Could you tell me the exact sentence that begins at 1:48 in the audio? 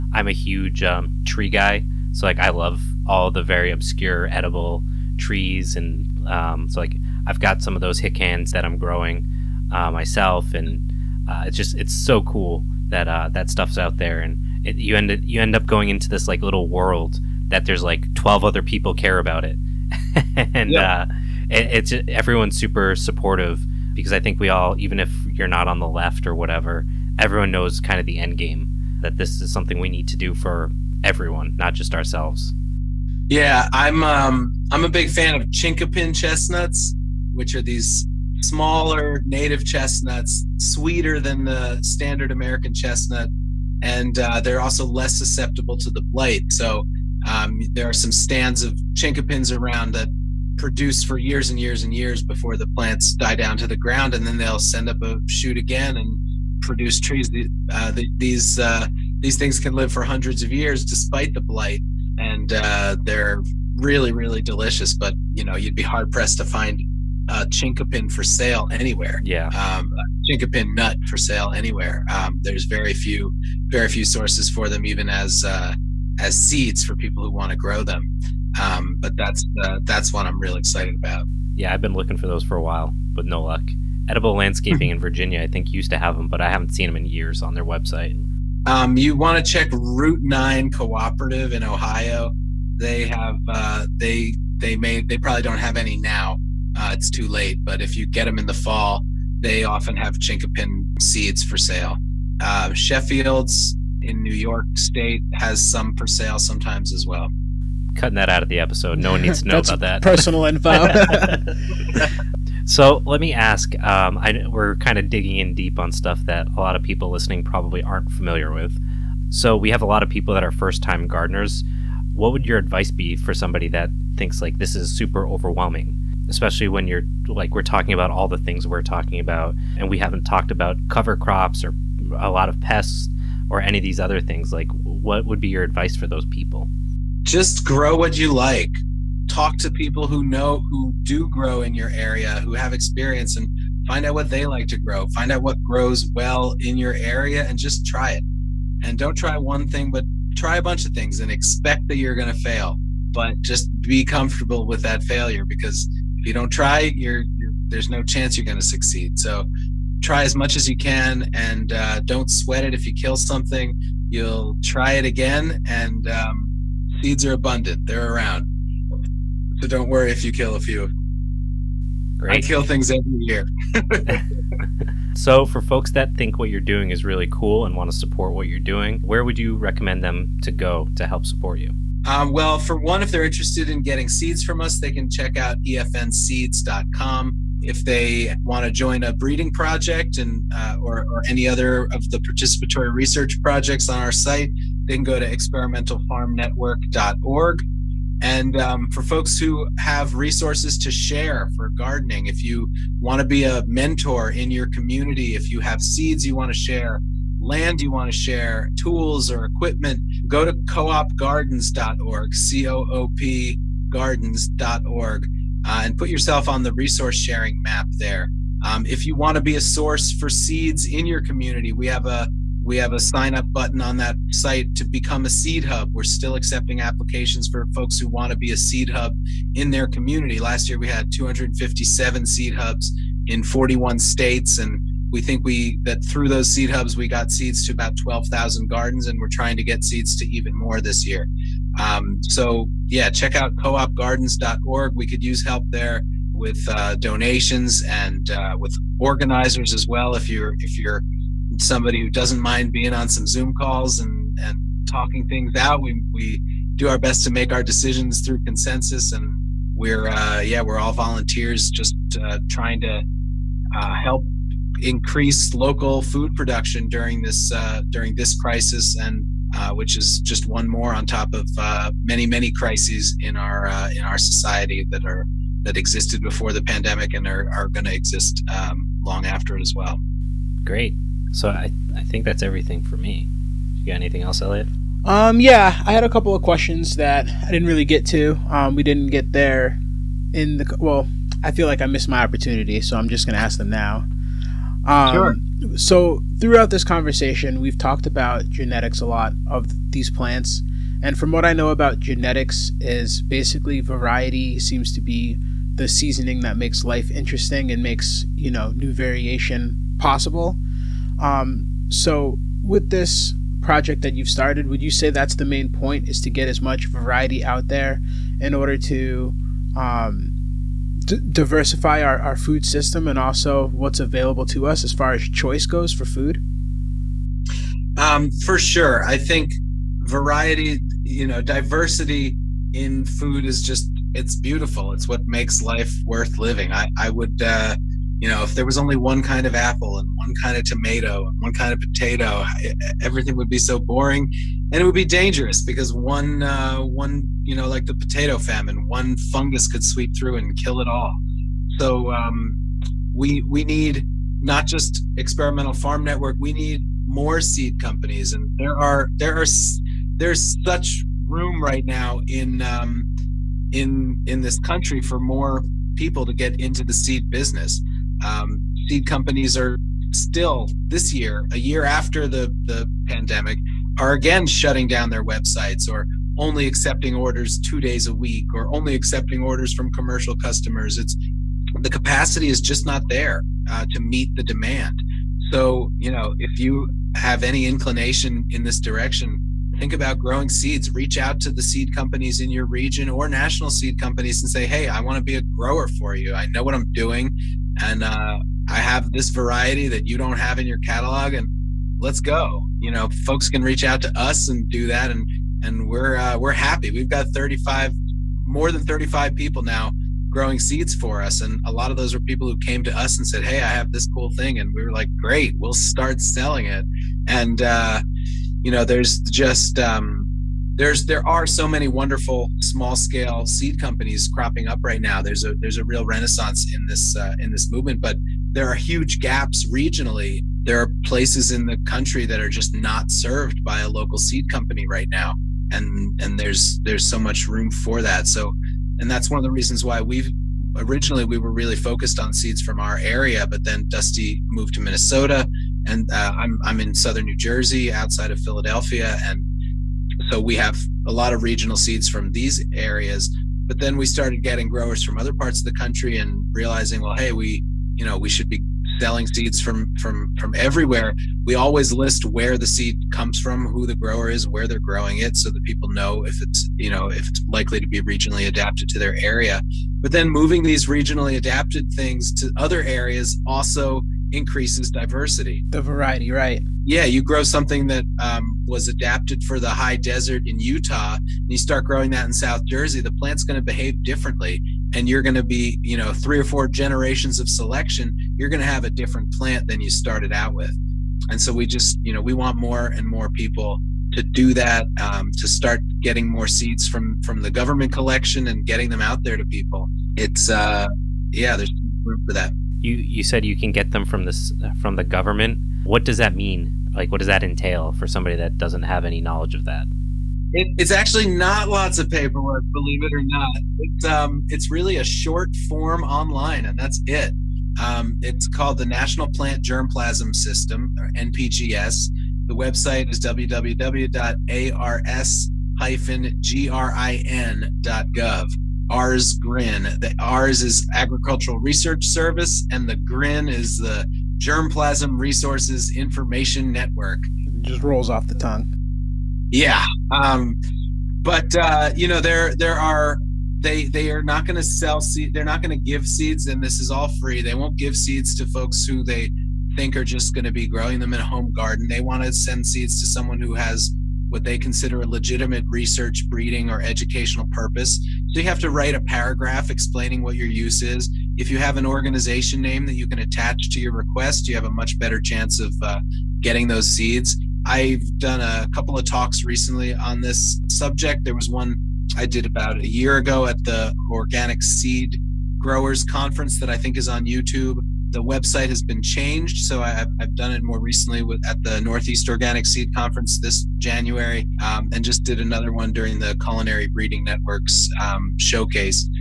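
No one needs to know about that.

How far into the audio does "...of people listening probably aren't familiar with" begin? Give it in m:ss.
1:56.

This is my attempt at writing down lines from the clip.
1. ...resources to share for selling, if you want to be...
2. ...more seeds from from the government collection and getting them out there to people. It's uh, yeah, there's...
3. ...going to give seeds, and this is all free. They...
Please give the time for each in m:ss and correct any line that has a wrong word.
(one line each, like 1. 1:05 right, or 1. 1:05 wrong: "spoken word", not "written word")
1. 3:20 wrong: "gardening", not "selling"
2. 8:16 right
3. 9:05 right.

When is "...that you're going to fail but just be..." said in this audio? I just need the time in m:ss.
2:31.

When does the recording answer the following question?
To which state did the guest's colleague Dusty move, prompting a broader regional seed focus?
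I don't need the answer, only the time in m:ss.
7:24.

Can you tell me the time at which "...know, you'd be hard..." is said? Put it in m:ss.
1:05.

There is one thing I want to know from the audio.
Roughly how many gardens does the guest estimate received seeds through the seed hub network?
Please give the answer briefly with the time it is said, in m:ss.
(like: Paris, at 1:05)
12,000, at 3:57.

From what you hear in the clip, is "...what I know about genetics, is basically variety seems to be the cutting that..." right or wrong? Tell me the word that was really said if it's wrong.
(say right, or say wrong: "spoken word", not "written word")
wrong: "seasoning", not "cutting".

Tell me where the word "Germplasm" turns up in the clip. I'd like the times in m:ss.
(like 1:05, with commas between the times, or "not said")
8:39, 8:54.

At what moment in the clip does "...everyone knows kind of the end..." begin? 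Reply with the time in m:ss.
0:27.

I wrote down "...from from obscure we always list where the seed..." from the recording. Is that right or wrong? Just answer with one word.
wrong.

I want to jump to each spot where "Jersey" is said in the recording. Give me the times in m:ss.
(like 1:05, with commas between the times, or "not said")
7:27, 8:02.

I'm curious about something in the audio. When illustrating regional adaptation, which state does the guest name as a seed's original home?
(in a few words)
Utah.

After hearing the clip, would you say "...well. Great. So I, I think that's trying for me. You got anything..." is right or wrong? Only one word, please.
wrong.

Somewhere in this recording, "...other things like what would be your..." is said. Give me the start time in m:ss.
2:13.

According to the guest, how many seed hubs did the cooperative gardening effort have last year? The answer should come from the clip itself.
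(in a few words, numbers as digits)
257.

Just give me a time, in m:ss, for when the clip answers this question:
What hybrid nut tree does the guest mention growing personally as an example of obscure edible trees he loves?
0:07.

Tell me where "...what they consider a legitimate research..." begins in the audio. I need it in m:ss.
9:14.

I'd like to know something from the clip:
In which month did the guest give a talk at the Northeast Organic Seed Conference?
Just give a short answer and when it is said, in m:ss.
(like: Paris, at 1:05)
January, at 9:43.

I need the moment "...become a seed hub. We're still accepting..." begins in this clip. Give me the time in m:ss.
3:44.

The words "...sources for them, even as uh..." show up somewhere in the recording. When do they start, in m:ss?
1:14.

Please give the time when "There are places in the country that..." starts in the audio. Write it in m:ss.
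7:10.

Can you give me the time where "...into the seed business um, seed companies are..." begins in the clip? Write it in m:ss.
6:06.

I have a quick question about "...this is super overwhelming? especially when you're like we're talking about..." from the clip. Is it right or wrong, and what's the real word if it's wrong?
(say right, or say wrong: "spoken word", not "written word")
right.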